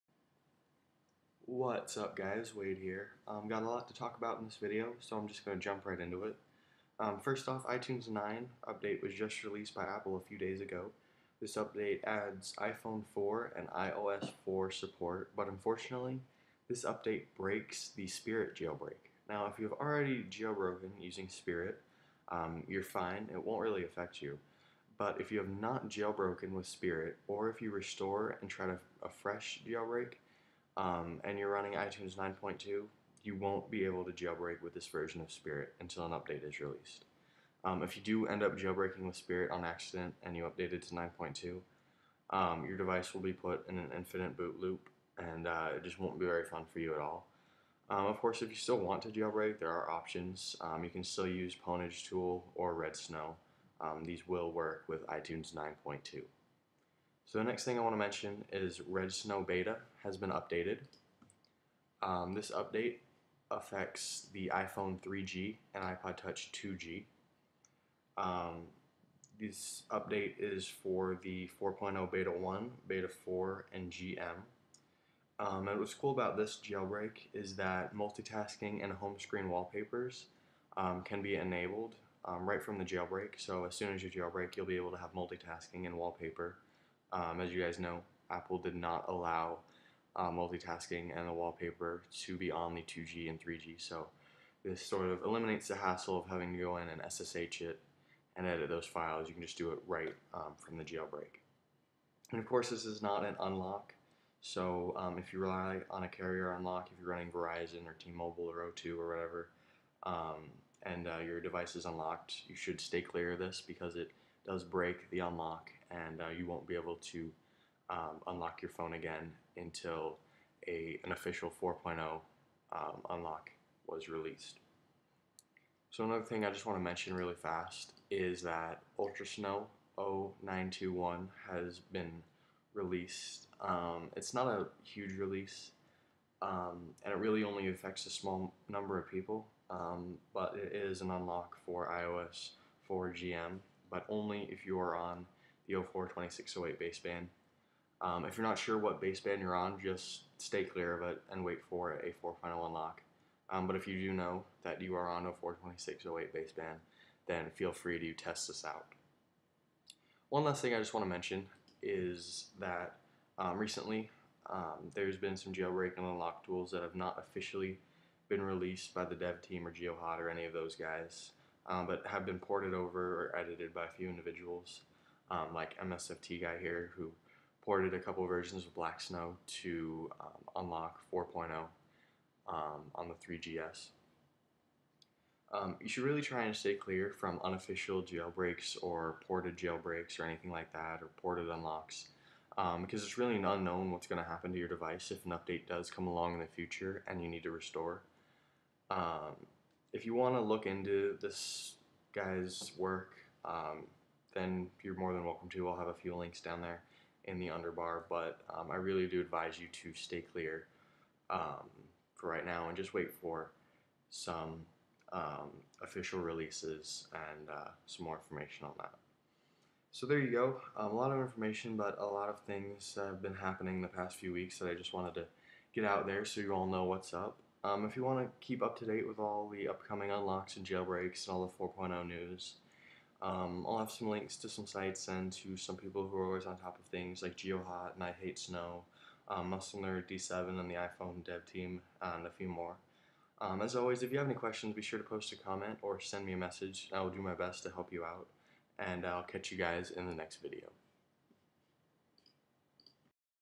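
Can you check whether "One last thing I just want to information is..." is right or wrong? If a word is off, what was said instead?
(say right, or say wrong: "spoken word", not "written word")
wrong: "mention", not "information".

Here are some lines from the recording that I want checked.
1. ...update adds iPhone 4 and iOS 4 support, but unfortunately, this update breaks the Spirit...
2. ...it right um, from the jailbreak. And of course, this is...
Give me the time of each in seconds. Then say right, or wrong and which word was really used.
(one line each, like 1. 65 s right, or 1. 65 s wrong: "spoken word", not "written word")
1. 11 s right
2. 99 s right.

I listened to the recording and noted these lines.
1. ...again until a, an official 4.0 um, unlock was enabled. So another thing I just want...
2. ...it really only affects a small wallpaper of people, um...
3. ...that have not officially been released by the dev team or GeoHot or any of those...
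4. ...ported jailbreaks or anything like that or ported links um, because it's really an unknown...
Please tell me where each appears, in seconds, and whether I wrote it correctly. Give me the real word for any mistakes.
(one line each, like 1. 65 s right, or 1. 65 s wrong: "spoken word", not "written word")
1. 118 s wrong: "released", not "enabled"
2. 137 s wrong: "number", not "wallpaper"
3. 166 s right
4. 189 s wrong: "unlocks", not "links".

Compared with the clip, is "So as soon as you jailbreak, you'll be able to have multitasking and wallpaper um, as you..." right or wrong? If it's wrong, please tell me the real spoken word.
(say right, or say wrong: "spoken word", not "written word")
right.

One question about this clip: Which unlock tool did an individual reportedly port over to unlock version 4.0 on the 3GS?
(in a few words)
Blacksn0w.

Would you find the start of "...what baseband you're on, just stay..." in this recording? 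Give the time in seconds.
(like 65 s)
148 s.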